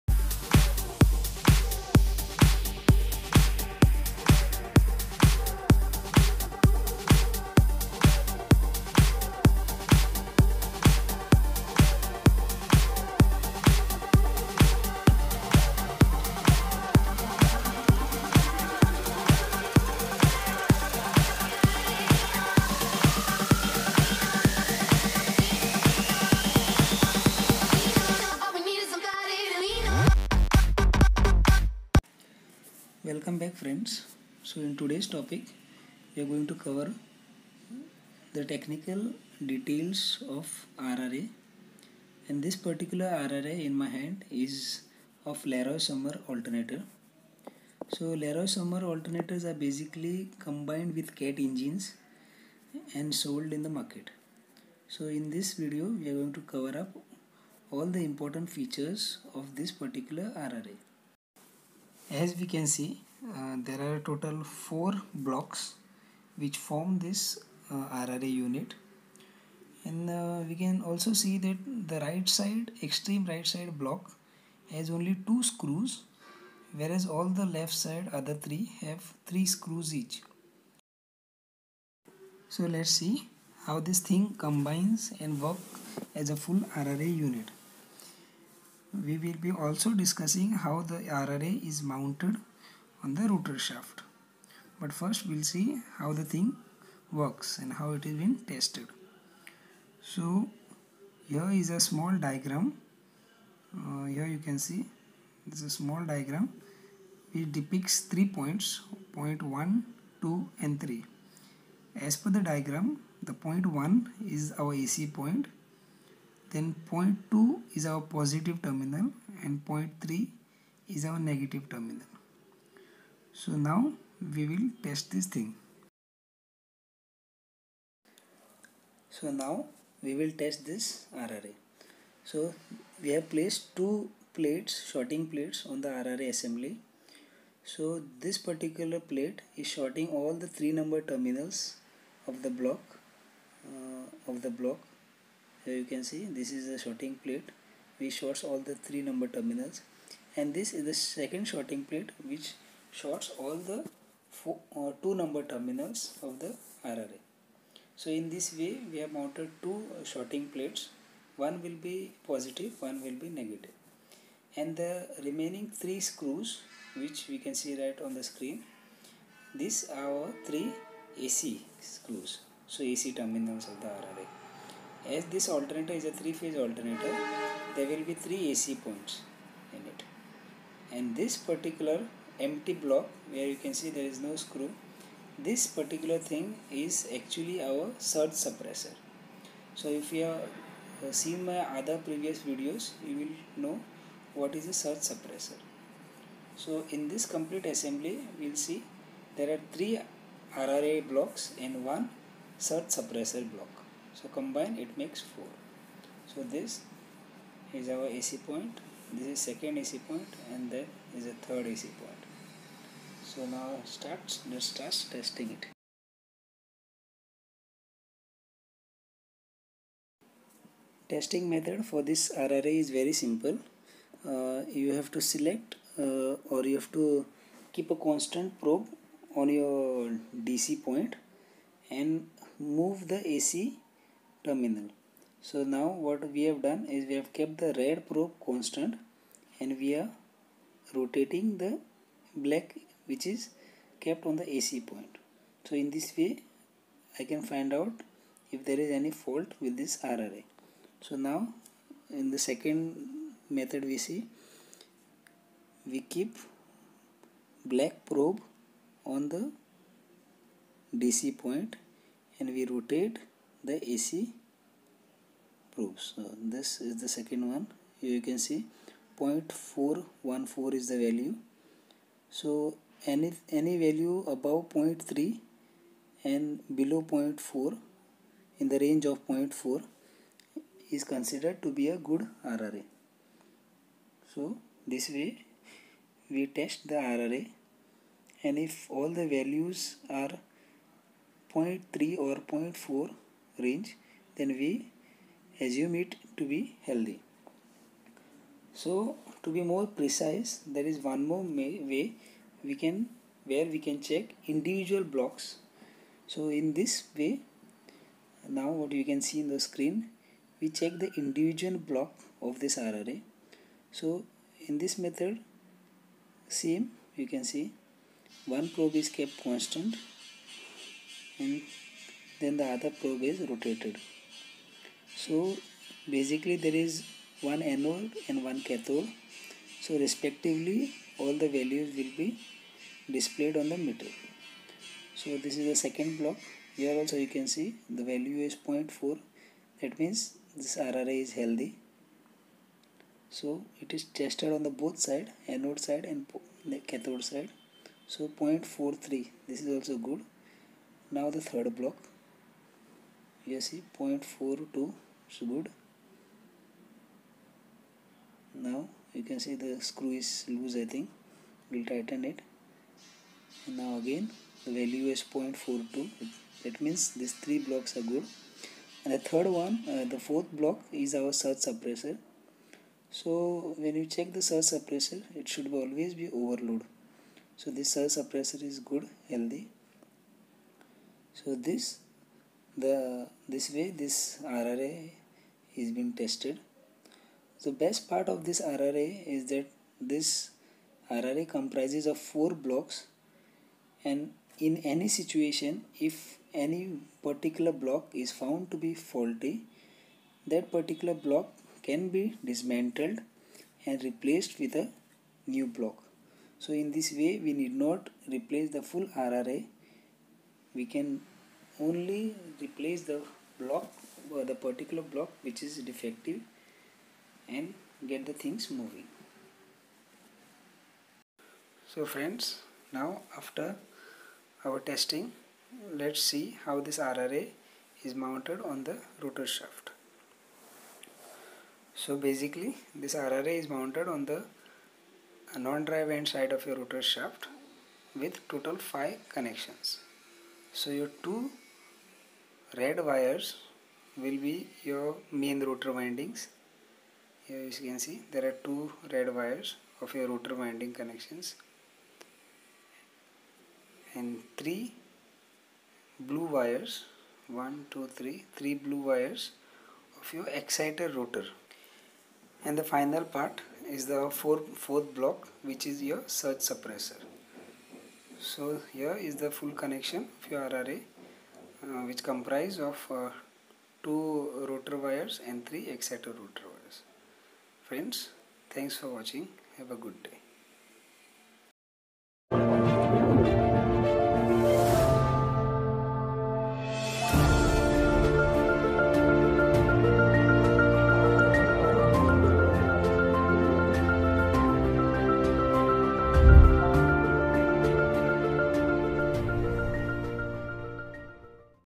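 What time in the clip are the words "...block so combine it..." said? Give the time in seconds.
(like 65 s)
203 s.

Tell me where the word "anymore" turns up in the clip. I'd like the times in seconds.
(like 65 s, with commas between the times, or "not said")
not said.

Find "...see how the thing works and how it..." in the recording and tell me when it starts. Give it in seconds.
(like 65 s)
95 s.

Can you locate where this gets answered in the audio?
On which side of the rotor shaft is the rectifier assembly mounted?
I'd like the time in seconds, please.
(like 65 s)
435 s.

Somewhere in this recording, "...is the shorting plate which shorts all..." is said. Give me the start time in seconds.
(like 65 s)
146 s.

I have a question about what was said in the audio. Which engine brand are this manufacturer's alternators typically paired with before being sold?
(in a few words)
Cat.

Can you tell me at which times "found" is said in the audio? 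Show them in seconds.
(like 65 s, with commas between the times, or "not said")
398 s.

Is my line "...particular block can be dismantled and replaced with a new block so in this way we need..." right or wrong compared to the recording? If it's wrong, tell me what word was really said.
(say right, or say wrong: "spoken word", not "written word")
right.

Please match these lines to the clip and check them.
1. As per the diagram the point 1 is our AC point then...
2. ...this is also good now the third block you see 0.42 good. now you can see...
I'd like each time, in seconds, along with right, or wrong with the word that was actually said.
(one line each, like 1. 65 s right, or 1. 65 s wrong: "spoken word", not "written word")
1. 112 s right
2. 349 s right.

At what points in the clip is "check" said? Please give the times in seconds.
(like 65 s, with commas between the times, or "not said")
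304 s, 310 s, 374 s.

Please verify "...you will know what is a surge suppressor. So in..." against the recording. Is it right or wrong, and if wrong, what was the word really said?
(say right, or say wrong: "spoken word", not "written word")
right.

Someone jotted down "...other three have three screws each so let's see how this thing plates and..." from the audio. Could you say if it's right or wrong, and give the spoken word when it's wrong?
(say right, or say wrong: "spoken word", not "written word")
wrong: "combines", not "plates".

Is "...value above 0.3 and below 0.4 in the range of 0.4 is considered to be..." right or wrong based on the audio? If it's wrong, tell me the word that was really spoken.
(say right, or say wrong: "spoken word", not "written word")
right.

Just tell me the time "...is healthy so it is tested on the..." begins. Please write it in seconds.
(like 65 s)
341 s.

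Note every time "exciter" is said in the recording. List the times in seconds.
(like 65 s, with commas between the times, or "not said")
460 s, 475 s.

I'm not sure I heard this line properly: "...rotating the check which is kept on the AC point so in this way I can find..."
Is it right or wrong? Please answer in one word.
wrong.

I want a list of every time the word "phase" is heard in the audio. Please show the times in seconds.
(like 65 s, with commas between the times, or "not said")
176 s.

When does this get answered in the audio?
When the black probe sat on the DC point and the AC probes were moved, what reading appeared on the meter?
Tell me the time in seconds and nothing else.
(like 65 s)
269 s.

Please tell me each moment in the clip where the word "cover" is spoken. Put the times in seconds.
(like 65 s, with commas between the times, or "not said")
36 s, 56 s.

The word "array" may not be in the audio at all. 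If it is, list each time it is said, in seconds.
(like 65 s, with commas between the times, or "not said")
222 s, 312 s, 470 s.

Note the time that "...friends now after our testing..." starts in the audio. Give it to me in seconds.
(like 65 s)
422 s.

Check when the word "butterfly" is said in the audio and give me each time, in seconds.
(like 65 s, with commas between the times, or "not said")
not said.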